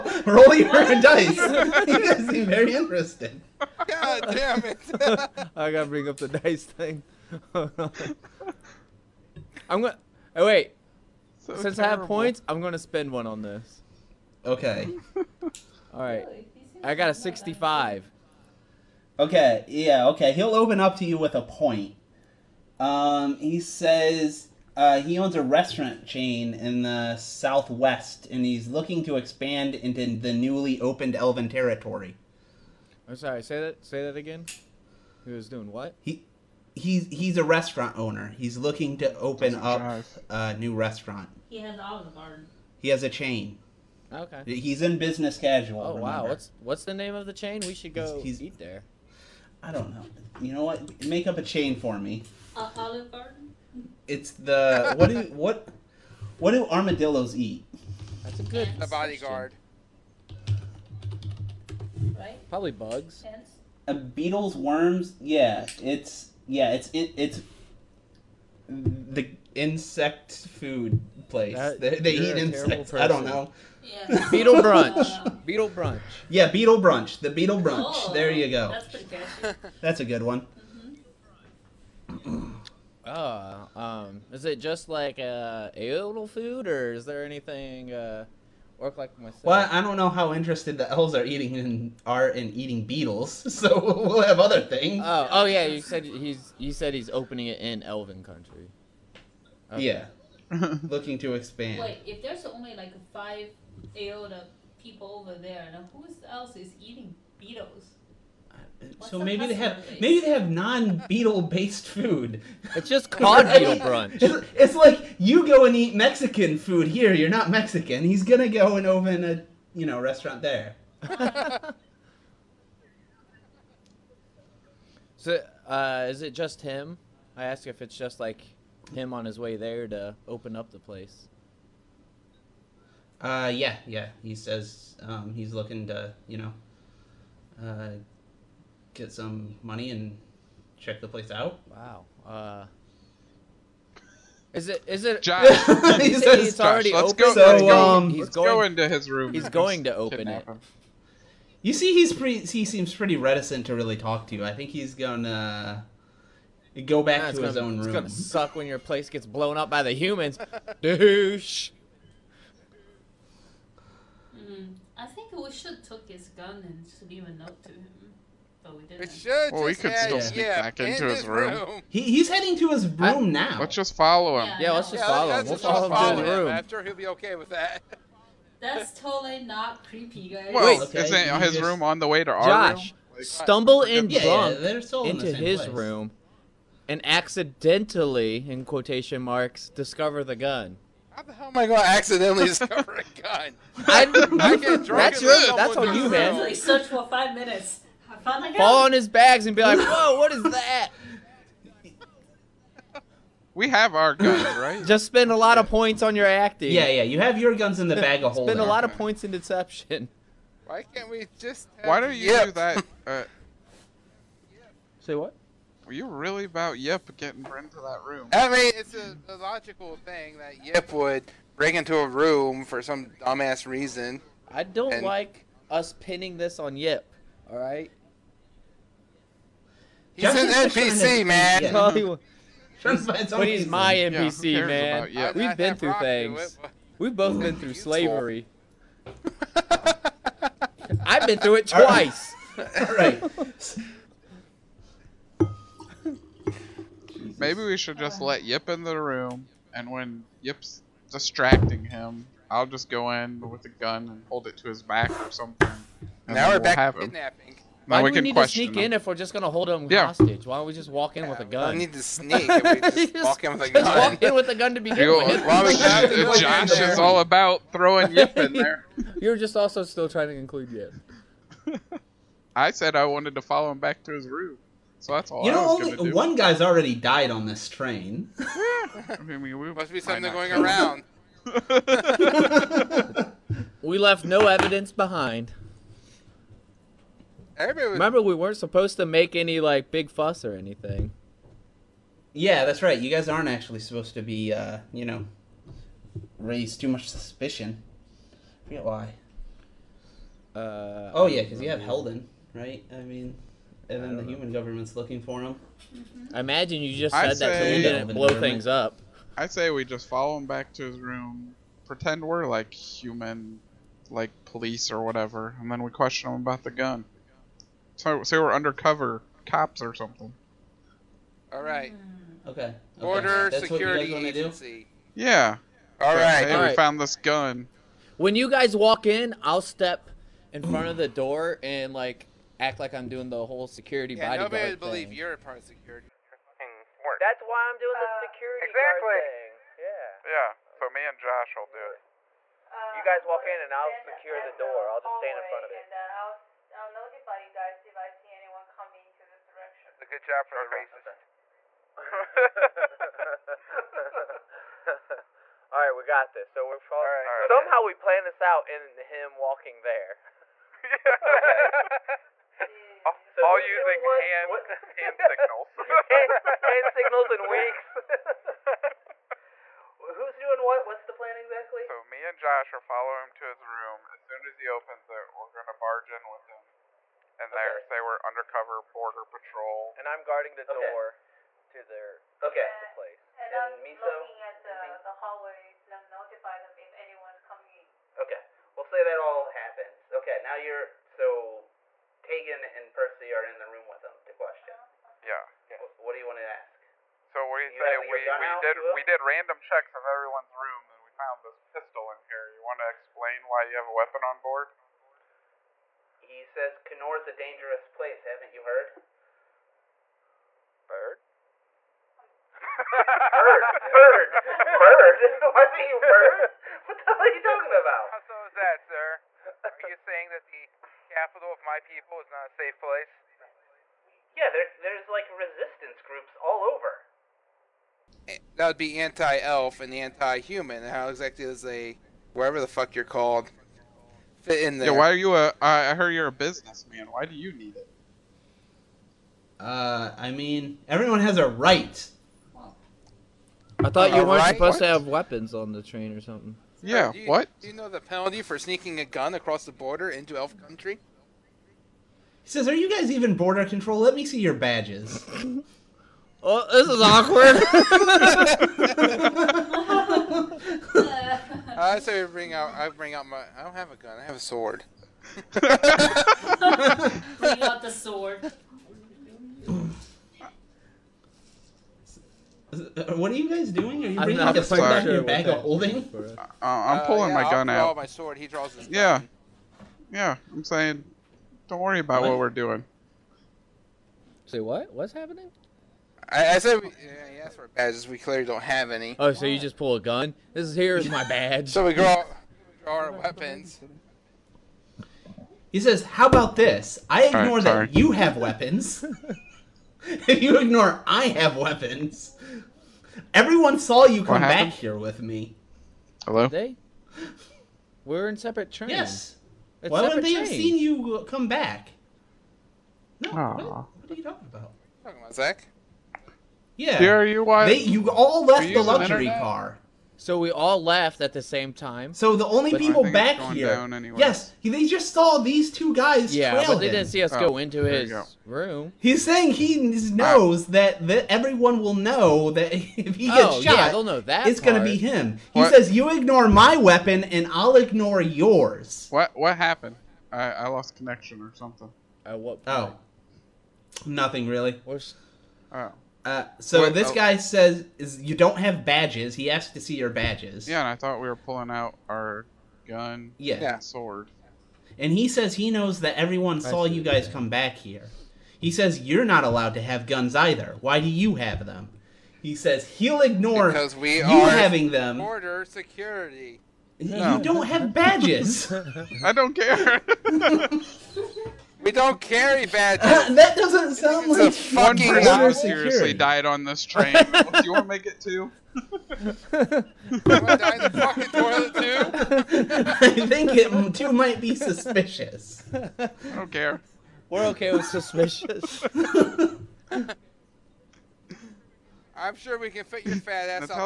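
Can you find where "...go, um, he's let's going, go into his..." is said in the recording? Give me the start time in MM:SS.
02:27.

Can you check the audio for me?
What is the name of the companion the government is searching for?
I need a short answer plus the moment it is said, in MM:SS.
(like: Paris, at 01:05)
Helden, at 05:01.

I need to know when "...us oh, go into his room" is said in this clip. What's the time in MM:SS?
08:47.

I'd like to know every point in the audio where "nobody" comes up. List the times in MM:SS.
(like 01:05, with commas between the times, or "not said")
05:34.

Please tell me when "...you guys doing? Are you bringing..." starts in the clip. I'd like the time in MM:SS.
07:53.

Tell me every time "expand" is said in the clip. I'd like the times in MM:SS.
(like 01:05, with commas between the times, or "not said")
00:29, 01:41.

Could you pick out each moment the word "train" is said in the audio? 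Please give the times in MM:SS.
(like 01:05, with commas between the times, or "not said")
04:37, 07:25, 08:28, 09:36.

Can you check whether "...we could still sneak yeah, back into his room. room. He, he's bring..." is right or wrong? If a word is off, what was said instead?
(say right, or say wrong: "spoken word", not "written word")
wrong: "heading", not "bring".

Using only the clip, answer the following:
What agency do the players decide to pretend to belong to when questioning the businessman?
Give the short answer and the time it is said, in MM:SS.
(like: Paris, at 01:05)
Border security agency, at 05:22.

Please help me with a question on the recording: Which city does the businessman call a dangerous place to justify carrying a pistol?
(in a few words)
Kenore.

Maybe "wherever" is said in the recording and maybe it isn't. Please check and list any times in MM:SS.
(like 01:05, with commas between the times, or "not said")
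07:12.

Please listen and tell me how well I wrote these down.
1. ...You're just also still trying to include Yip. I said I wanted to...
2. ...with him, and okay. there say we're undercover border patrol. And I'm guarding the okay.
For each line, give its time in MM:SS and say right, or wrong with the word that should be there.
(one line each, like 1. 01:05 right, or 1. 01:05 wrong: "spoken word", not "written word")
1. 04:29 right
2. 06:16 right.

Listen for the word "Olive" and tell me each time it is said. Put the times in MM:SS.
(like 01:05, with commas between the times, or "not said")
00:41, 00:52.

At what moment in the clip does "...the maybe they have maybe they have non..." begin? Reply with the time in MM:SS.
01:49.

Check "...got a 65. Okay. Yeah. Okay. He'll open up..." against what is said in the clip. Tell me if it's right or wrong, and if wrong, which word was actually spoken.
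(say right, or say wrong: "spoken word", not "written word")
right.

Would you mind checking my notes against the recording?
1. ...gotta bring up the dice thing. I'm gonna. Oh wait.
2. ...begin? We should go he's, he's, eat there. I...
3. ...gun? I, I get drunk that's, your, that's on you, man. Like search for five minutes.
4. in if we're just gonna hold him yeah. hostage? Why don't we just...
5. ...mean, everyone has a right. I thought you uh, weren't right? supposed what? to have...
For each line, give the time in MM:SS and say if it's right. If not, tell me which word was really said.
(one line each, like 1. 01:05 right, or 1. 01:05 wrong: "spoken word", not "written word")
1. 00:05 right
2. 00:47 wrong: "chain", not "begin"
3. 03:13 right
4. 04:18 right
5. 07:20 right.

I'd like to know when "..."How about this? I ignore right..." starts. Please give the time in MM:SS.
08:16.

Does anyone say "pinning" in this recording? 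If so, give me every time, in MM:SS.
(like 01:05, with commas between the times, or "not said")
03:45.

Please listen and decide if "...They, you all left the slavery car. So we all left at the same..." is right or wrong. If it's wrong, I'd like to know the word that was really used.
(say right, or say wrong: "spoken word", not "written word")
wrong: "luxury", not "slavery".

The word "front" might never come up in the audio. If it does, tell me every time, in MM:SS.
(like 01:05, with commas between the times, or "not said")
05:30, 05:45.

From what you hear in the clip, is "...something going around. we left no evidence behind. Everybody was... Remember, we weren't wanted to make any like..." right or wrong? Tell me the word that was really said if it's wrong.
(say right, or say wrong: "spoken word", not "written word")
wrong: "supposed", not "wanted".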